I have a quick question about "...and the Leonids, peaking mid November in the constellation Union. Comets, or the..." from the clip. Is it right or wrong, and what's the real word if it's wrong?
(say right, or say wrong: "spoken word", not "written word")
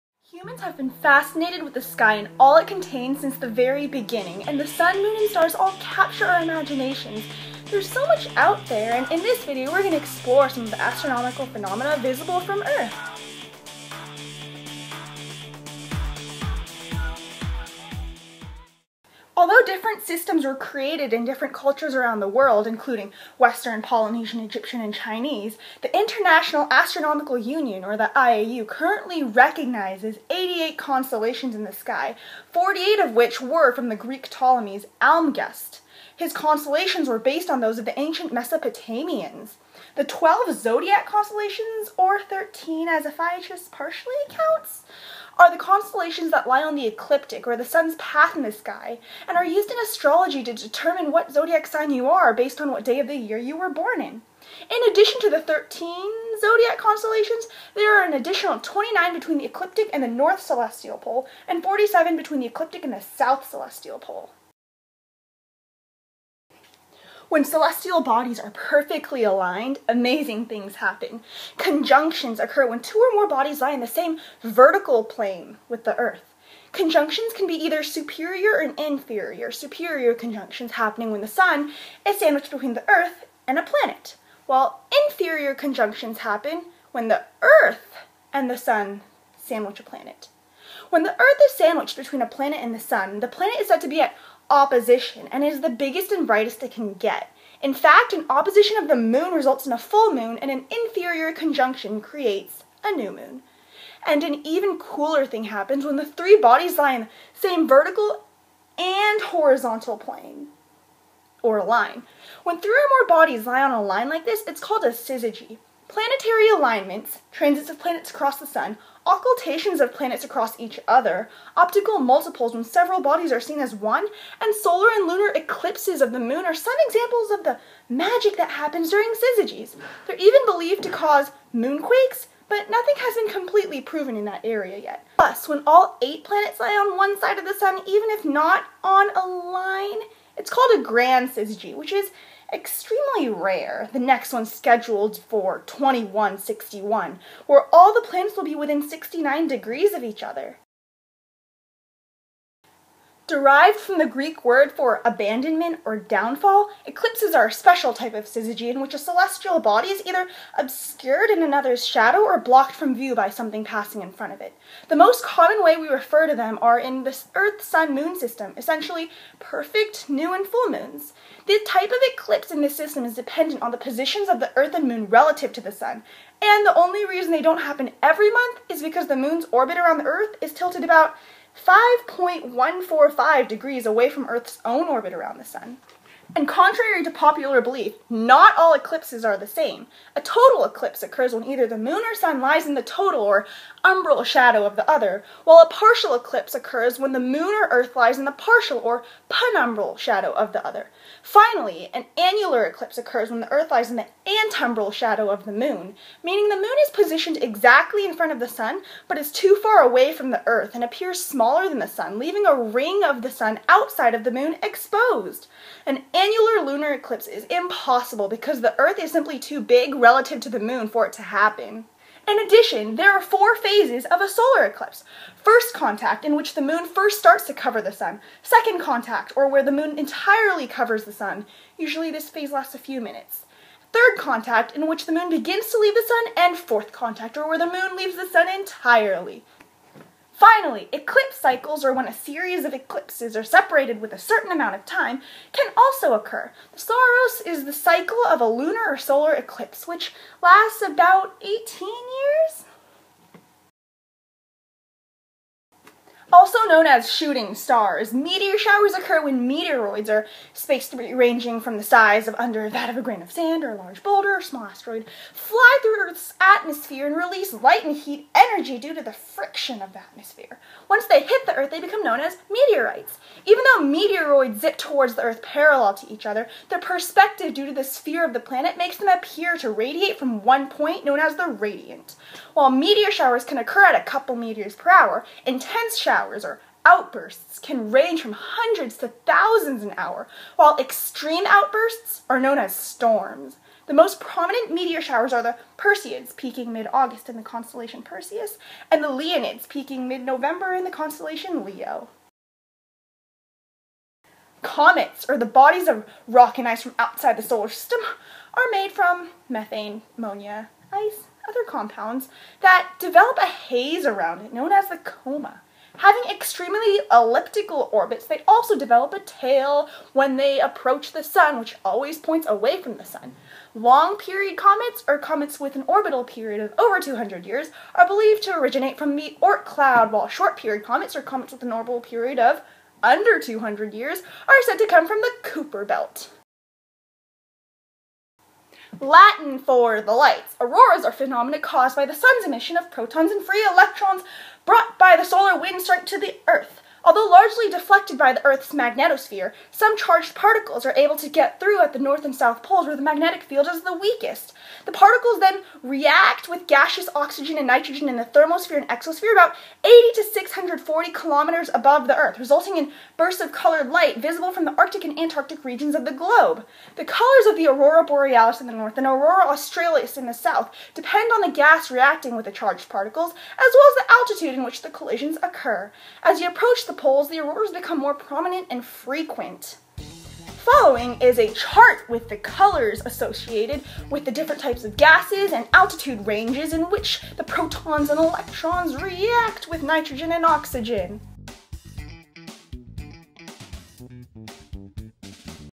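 wrong: "Leo", not "Union".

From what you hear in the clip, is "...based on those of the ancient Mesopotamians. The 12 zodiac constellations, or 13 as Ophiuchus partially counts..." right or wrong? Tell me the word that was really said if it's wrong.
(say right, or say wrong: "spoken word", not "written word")
right.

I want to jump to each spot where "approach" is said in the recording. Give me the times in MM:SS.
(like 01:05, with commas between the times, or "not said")
05:20, 06:16.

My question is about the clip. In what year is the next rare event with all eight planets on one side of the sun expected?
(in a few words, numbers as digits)
2161.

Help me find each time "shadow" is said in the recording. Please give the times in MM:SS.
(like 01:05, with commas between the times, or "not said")
02:41, 03:14, 03:19, 03:24.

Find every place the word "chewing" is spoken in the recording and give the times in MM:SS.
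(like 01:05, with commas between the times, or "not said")
not said.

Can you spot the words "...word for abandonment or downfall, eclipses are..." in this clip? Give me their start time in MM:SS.
02:34.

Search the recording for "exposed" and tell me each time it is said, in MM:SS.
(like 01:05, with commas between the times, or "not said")
03:34.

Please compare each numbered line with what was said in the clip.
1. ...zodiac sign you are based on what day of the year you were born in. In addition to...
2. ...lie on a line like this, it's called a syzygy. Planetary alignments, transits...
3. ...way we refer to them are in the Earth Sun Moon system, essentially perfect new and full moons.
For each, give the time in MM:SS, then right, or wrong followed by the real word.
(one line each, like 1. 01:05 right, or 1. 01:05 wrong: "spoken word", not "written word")
1. 00:51 right
2. 01:53 right
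3. 02:45 right.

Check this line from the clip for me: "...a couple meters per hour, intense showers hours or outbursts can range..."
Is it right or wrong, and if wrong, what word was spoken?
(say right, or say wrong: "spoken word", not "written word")
right.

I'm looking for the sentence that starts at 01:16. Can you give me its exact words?
Conjunctions can be either superior or inferior.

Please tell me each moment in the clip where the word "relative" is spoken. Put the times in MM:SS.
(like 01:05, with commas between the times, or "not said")
02:55, 03:39.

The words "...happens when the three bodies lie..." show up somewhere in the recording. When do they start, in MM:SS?
01:45.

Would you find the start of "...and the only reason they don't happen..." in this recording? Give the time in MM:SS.
02:56.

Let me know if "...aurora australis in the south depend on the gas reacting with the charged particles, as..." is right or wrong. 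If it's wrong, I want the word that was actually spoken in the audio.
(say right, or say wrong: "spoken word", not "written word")
right.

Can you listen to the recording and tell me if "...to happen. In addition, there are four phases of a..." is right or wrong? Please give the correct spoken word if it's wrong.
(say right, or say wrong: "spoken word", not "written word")
right.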